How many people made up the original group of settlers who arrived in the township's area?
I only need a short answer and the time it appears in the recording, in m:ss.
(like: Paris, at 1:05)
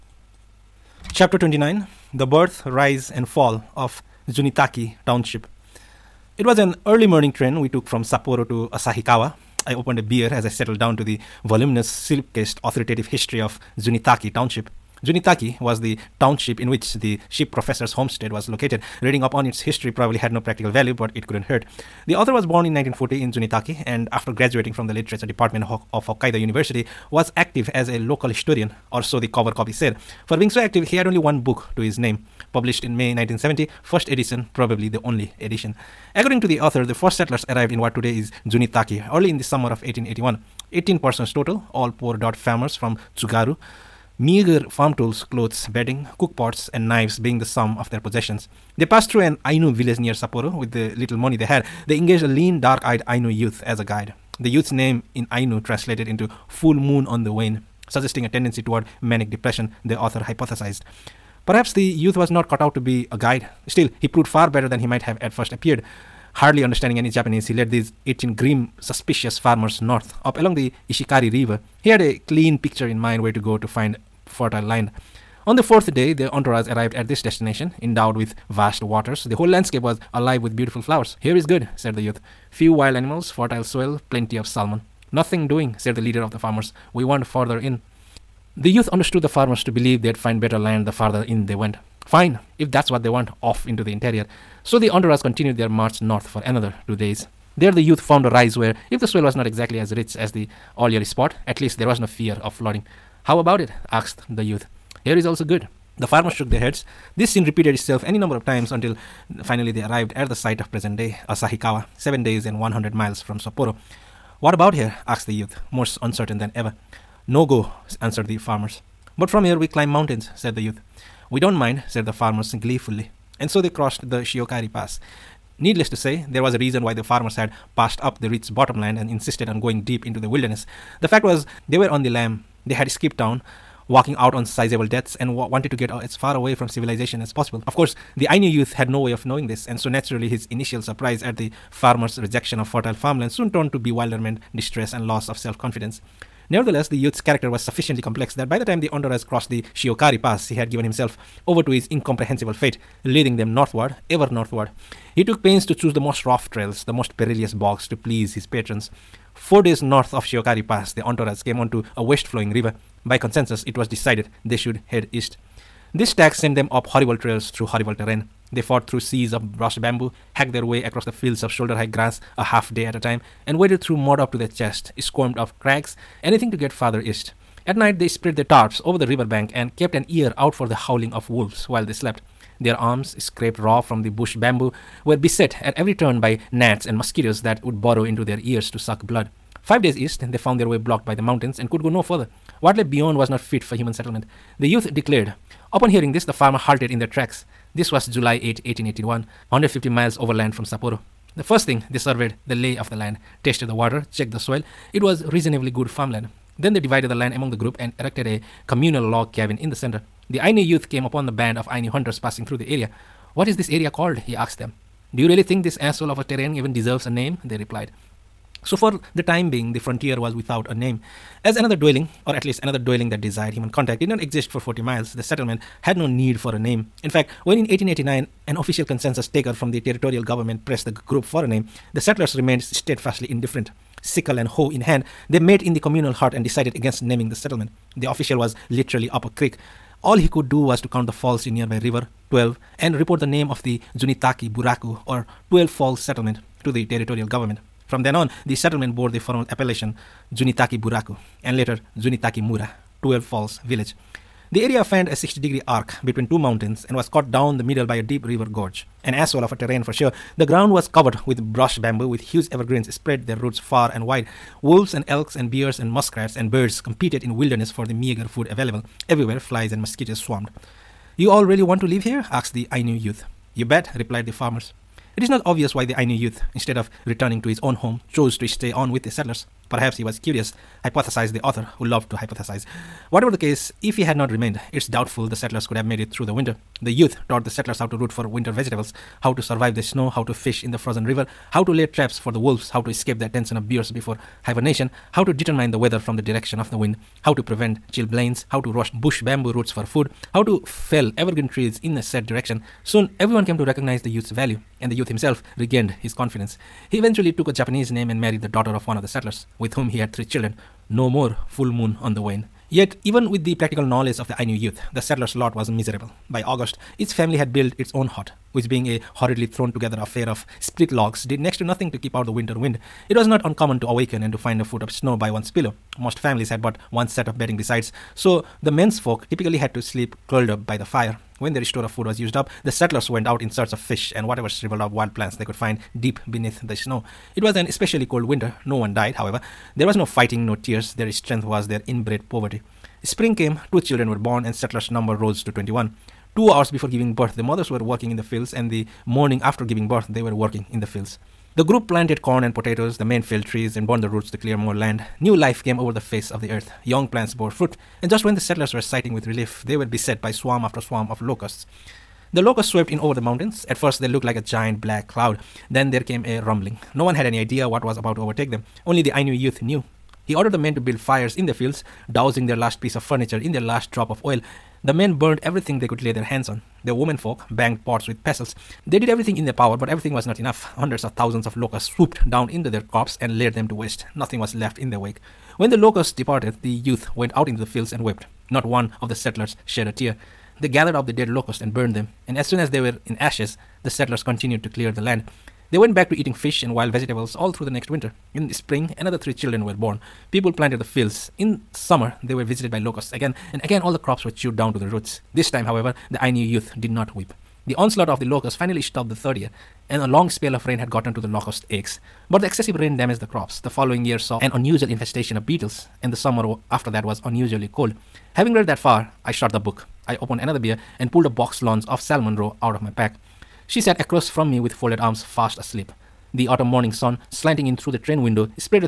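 18, at 0:40.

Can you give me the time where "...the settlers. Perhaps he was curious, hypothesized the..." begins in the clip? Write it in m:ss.
4:39.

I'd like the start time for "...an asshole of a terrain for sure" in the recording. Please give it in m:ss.
4:19.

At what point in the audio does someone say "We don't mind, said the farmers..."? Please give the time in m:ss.
2:01.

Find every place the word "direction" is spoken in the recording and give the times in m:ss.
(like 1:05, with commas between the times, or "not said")
4:56, 5:02.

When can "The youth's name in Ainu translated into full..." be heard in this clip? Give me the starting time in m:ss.
0:54.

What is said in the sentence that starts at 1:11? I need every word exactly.
He had a clean picture in mind where to go to find fertile land.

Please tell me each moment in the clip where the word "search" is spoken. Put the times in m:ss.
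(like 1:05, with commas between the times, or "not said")
5:33.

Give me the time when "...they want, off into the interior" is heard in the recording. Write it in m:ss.
1:33.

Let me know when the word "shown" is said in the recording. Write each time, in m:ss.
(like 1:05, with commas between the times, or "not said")
not said.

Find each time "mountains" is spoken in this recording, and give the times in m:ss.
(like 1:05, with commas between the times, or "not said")
1:59, 3:11, 4:16, 6:03.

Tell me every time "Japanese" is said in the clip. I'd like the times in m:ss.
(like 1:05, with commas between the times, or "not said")
1:07, 5:07.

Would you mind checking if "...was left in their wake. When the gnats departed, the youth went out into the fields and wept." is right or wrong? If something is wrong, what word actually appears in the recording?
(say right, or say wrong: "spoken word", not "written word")
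wrong: "locusts", not "gnats".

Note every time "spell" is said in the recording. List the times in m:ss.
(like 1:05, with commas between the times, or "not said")
6:50.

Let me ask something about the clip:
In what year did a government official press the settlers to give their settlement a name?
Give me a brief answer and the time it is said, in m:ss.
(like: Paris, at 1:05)
1889, at 3:47.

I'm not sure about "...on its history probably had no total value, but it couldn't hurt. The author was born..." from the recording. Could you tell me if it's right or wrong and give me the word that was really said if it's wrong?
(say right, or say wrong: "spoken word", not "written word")
wrong: "practical", not "total".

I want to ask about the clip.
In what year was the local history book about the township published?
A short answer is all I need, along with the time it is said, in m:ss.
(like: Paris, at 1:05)
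1970, at 0:32.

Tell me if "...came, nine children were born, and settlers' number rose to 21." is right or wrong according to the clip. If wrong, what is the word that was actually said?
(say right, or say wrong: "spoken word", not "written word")
wrong: "two", not "nine".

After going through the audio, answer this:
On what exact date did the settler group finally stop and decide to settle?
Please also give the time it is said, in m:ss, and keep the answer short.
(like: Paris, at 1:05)
July 8, 1881, at 3:18.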